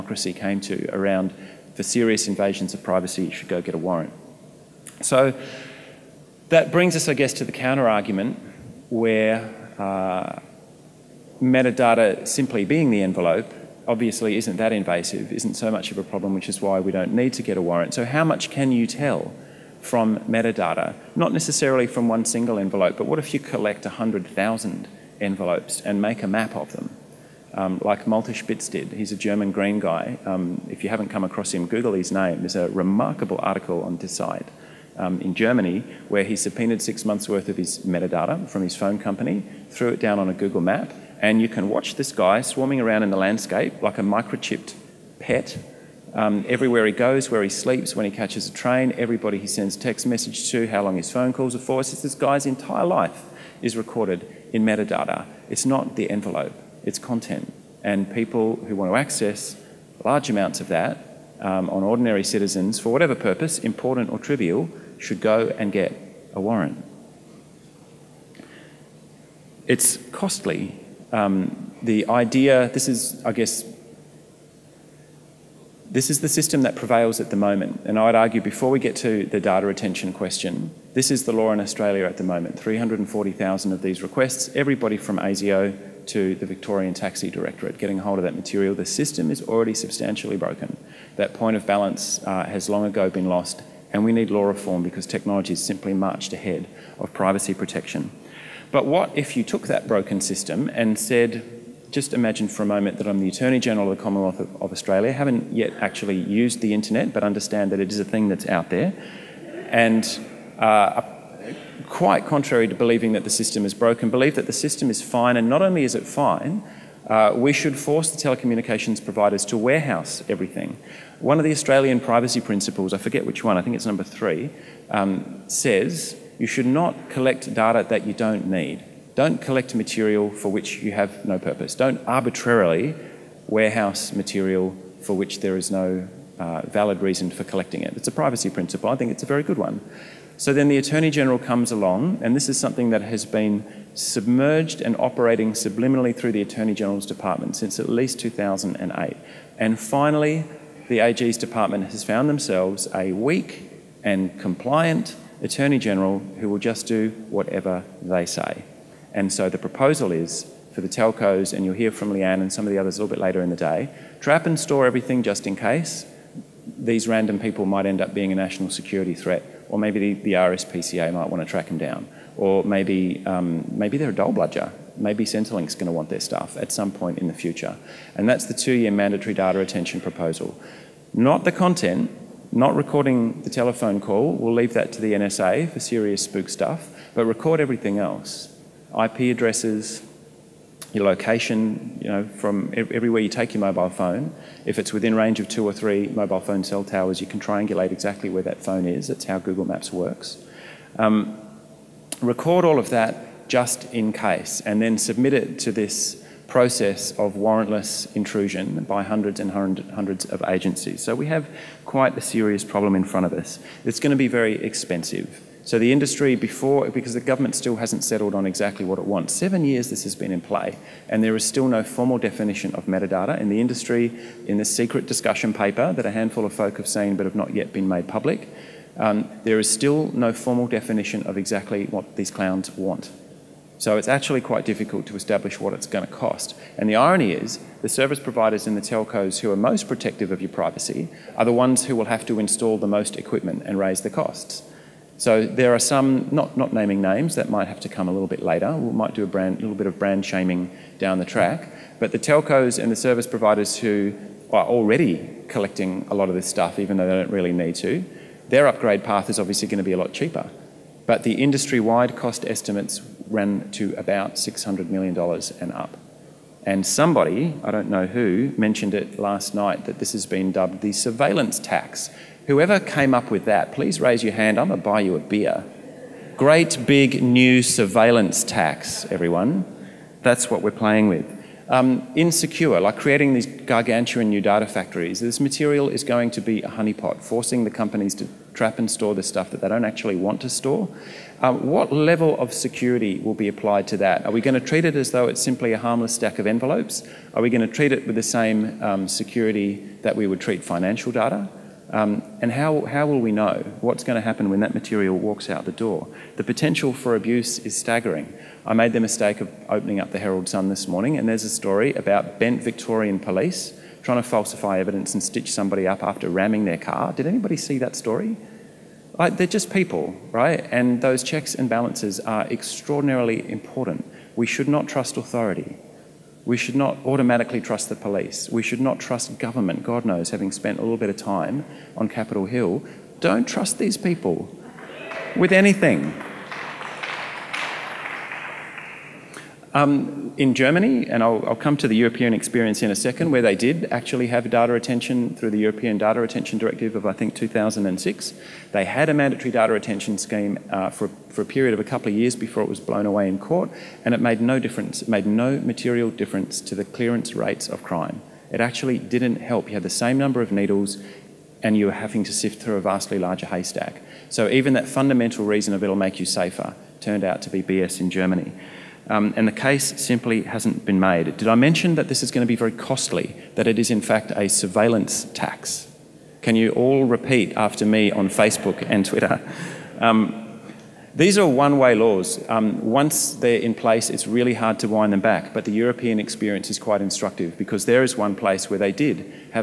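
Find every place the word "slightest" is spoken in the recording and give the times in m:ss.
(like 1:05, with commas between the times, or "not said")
not said.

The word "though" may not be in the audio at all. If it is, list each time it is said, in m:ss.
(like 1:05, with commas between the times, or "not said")
4:16, 4:55.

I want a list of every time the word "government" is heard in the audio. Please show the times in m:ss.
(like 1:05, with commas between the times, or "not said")
3:37, 5:29.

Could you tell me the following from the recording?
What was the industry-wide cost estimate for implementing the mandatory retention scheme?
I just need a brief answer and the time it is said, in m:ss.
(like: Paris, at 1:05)
$600 million, at 4:24.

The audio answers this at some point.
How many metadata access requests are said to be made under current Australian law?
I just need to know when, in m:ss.
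1:22.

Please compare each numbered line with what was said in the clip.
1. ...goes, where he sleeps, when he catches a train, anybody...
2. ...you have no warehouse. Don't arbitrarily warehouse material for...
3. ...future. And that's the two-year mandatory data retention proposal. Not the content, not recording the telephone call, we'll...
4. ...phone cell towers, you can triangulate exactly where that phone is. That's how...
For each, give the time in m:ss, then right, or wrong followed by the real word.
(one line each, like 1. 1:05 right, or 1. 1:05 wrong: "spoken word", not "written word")
1. 0:46 wrong: "everybody", not "anybody"
2. 2:10 wrong: "purpose", not "warehouse"
3. 2:57 right
4. 3:16 right.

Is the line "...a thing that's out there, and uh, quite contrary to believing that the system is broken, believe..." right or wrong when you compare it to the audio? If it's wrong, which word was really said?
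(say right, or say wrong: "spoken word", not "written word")
right.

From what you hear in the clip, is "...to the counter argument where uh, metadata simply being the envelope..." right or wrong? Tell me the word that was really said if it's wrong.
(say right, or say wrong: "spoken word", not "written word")
right.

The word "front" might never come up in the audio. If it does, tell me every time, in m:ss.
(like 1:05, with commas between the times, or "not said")
3:33.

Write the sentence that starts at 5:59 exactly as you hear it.
You had the same number of needles, and you were having to sift through a vastly larger haystack.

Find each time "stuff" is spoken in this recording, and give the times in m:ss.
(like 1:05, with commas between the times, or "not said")
2:56, 3:06, 4:16, 4:49.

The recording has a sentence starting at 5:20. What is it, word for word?
And those checks and balances are extraordinarily important.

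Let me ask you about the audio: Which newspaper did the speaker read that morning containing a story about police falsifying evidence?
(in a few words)
Herald Sun.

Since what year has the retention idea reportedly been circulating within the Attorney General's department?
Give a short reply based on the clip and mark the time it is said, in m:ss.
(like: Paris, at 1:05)
2008, at 2:28.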